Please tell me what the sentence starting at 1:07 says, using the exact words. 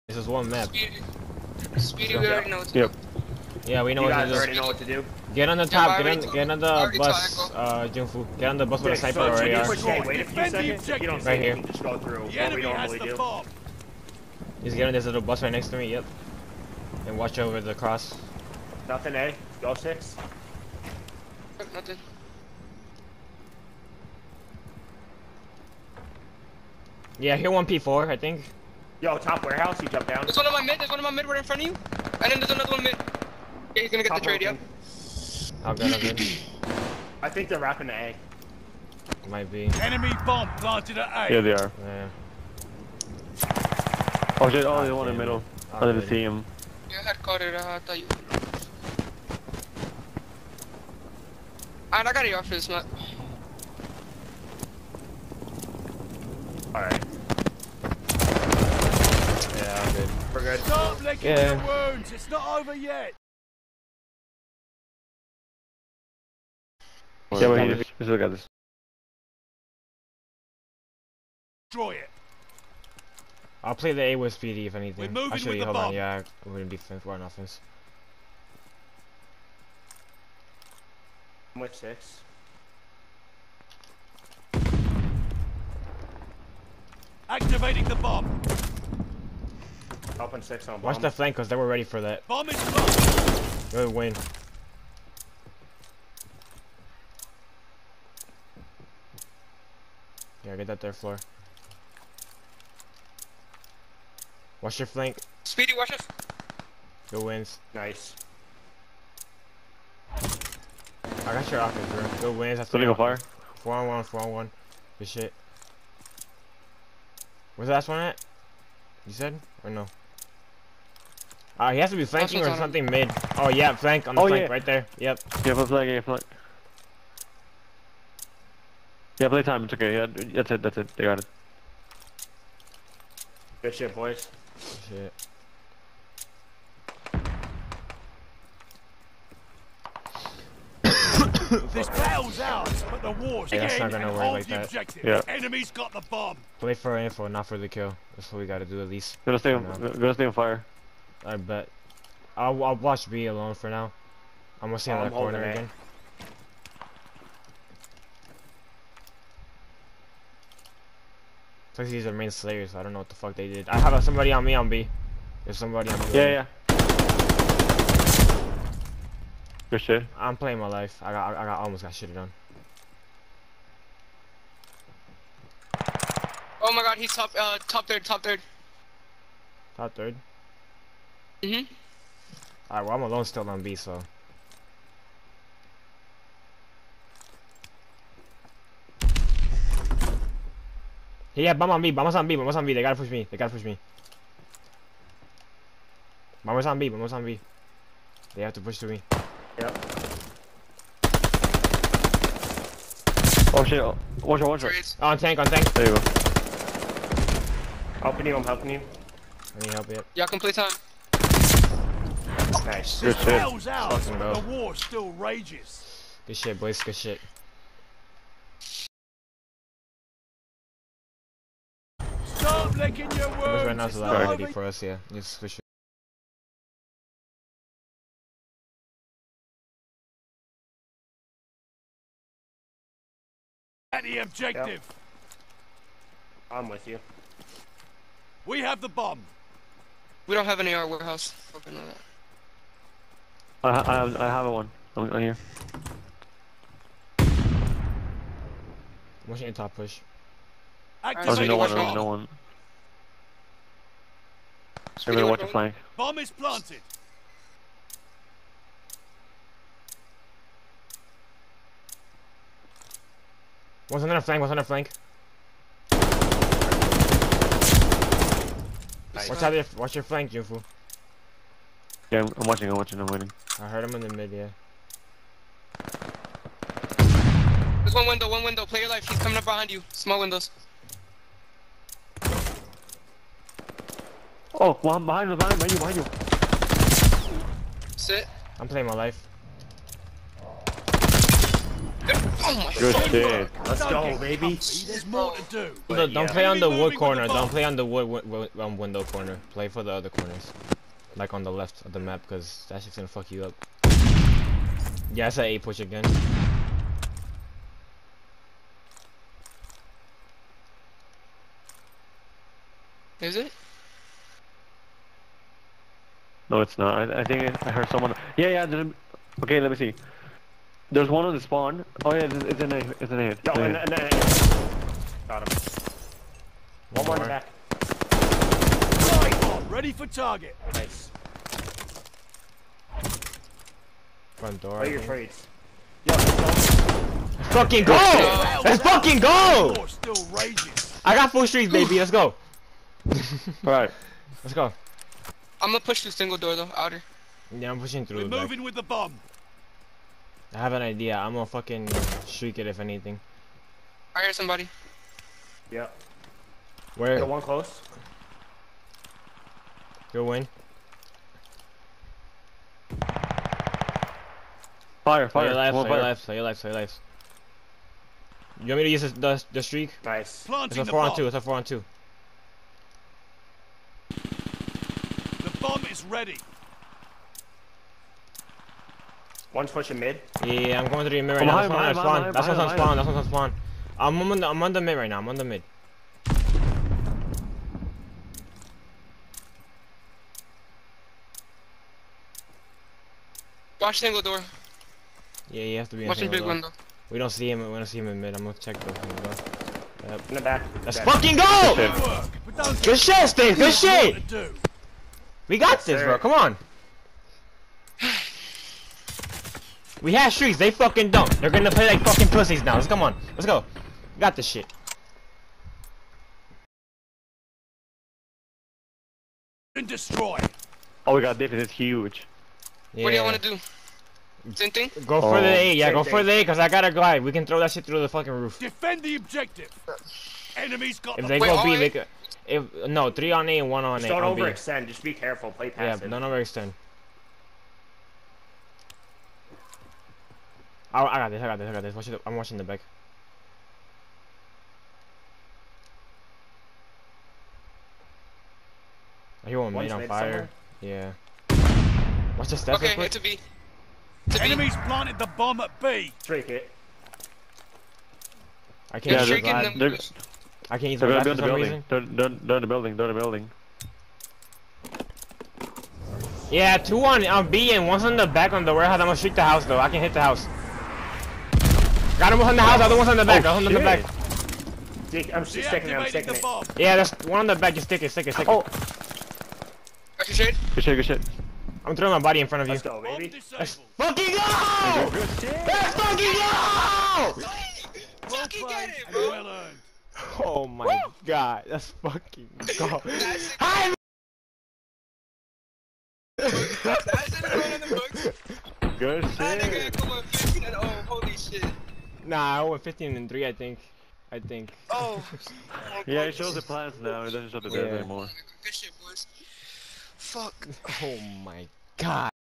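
Yeah, we, we still got this.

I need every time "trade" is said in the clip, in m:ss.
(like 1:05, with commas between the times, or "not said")
0:34, 5:34.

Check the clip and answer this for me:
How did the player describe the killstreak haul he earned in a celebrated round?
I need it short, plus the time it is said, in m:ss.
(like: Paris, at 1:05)
full streets, at 5:41.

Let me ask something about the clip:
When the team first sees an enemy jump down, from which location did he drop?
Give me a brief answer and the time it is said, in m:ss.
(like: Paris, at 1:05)
top warehouse, at 0:29.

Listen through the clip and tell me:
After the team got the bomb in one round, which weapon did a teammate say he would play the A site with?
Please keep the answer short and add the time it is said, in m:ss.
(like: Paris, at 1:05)
PD, at 1:14.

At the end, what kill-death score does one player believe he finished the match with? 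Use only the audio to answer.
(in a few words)
15 and 3.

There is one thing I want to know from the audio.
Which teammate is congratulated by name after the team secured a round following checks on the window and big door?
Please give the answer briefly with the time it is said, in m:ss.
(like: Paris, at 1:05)
Steve, at 6:43.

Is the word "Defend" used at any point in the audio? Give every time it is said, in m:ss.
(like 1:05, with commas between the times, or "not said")
7:08.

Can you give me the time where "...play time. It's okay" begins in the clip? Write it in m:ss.
2:09.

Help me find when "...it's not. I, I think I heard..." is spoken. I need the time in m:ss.
5:16.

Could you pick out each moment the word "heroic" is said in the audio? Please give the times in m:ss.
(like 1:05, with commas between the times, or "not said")
not said.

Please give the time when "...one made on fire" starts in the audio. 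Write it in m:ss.
7:29.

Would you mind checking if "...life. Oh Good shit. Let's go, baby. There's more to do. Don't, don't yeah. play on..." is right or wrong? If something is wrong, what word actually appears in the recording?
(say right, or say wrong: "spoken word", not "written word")
right.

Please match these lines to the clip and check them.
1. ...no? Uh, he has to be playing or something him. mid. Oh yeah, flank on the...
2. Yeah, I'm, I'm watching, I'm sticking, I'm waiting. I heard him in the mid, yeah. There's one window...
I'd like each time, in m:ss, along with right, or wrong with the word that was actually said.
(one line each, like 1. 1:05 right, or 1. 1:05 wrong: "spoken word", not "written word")
1. 1:59 wrong: "flanking", not "playing"
2. 4:32 wrong: "watching", not "sticking".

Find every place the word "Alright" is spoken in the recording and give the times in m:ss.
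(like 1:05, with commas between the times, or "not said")
0:56, 3:02, 5:43.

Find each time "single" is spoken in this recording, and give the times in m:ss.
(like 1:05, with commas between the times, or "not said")
5:46, 6:33.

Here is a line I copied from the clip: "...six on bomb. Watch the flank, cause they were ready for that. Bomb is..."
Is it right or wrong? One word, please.
right.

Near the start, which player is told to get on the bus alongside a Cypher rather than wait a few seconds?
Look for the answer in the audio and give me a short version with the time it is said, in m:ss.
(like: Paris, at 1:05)
Junfu, at 0:07.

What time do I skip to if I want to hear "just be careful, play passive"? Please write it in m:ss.
7:14.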